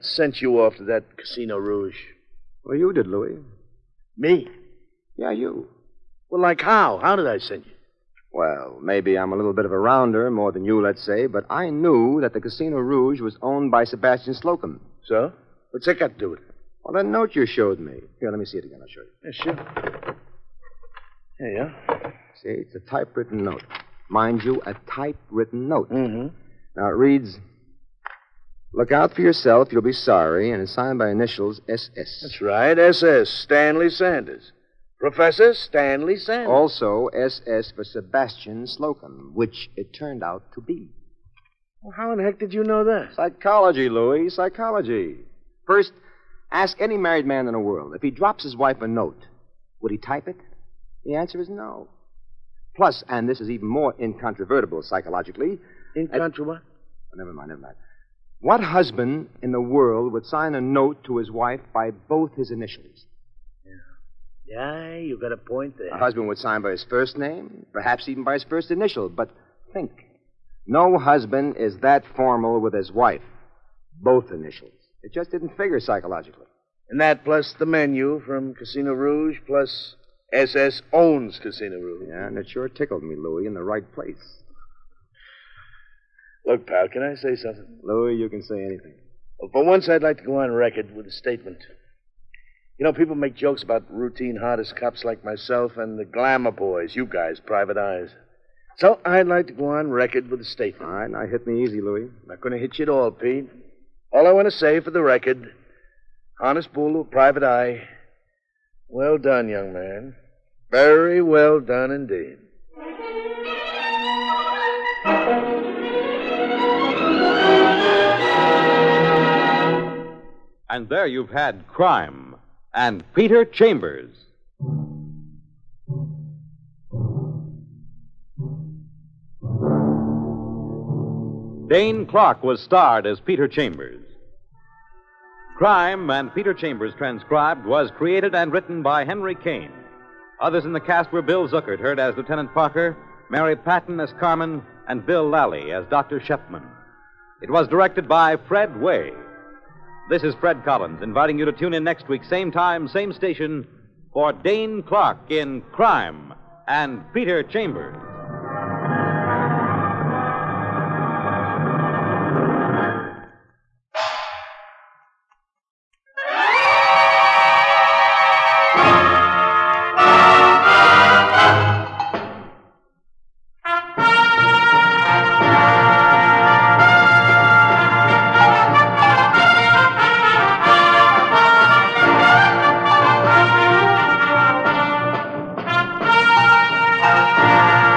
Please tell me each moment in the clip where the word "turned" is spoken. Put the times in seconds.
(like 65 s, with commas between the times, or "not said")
39 s.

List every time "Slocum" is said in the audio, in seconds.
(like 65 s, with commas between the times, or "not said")
14 s, 38 s.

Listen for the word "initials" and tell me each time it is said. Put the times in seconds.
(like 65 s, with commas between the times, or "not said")
31 s, 62 s, 68 s, 74 s.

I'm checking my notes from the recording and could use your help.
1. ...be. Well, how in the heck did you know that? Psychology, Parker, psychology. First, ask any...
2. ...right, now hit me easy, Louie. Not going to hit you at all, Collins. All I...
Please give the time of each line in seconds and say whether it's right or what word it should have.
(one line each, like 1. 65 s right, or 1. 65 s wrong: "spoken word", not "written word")
1. 40 s wrong: "Louis", not "Parker"
2. 100 s wrong: "Pete", not "Collins".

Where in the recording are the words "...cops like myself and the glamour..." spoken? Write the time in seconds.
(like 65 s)
94 s.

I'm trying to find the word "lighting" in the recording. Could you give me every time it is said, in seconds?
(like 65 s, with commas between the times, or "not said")
not said.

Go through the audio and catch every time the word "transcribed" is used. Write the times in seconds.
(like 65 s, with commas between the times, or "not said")
136 s.